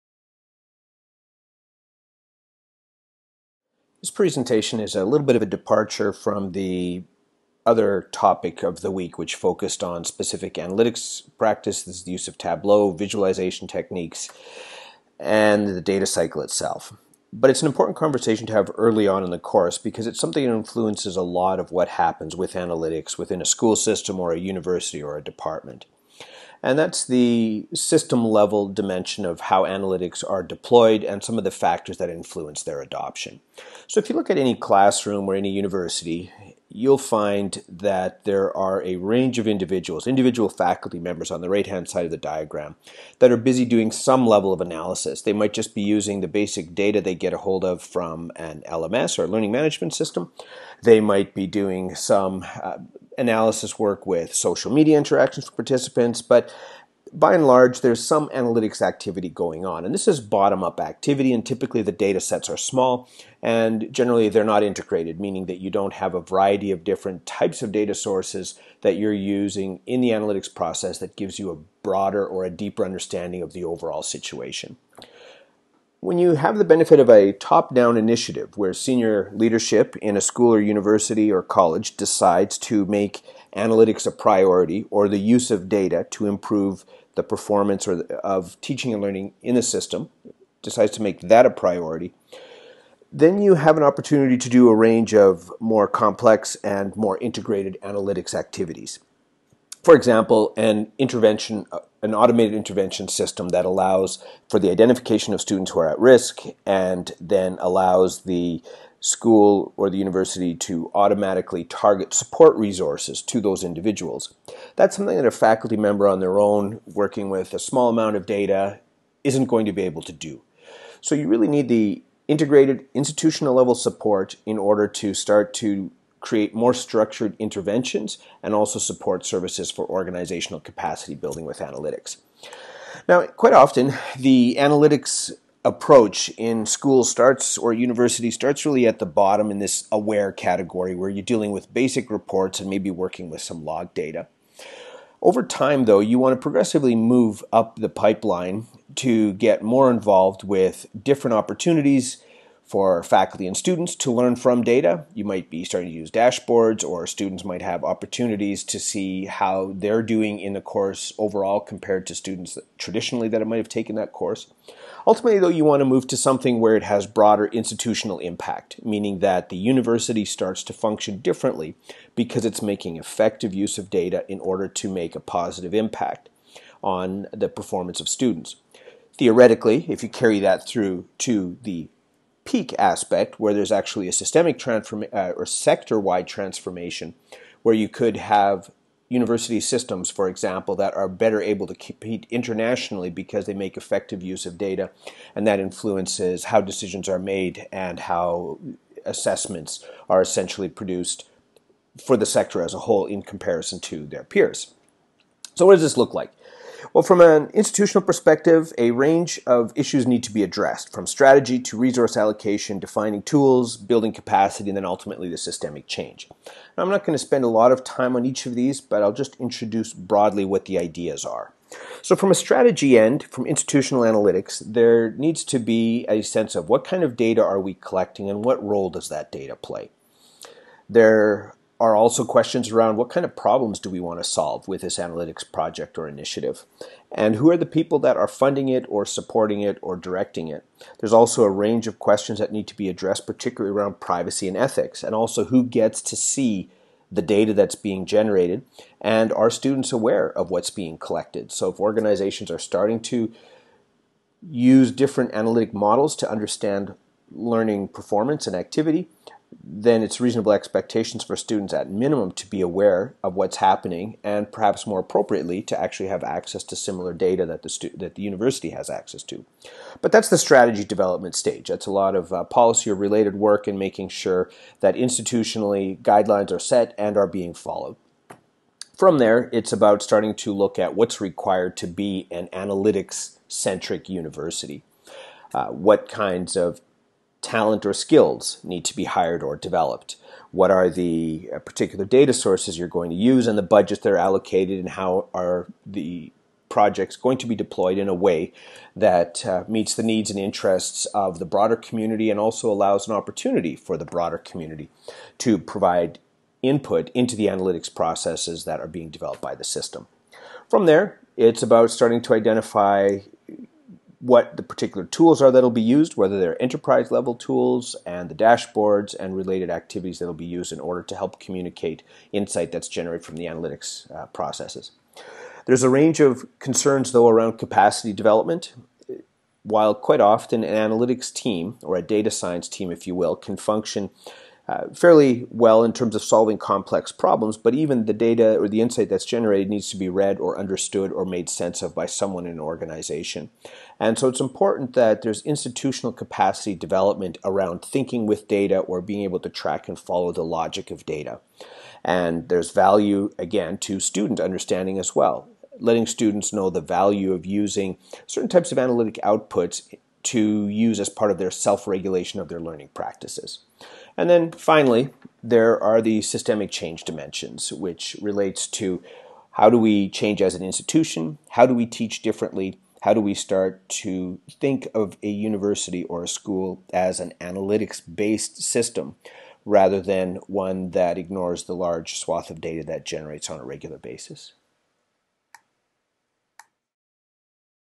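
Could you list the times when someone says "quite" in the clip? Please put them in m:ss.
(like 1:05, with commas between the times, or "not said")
2:13, 5:29.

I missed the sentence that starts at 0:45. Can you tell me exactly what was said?
They might just be using the basic data they get a hold of from an LMS or learning management system.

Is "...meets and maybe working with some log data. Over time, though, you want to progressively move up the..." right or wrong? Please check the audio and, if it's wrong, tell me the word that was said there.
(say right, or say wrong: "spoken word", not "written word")
wrong: "reports", not "meets".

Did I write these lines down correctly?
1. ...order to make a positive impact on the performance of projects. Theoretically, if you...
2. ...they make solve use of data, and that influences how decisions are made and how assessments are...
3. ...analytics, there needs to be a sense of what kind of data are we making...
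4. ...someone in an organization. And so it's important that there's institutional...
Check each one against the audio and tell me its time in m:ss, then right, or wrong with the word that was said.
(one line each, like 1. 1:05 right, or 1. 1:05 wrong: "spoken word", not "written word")
1. 2:54 wrong: "students", not "projects"
2. 3:13 wrong: "effective", not "solve"
3. 3:44 wrong: "collecting", not "making"
4. 5:42 right.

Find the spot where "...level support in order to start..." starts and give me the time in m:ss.
2:03.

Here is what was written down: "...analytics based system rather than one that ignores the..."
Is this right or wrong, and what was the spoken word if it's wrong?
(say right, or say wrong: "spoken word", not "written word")
right.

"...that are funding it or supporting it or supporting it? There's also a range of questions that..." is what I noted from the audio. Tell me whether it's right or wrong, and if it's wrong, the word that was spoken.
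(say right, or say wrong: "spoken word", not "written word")
wrong: "directing", not "supporting".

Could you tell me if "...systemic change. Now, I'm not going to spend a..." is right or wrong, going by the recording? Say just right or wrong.
right.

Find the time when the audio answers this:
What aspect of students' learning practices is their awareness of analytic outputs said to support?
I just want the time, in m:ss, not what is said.
6:01.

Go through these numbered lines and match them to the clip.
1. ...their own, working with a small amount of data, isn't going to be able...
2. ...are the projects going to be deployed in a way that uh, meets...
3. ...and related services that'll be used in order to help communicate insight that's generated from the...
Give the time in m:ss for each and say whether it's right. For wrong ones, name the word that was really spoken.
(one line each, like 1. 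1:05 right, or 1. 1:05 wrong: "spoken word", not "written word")
1. 1:56 right
2. 4:55 right
3. 5:19 wrong: "activities", not "services".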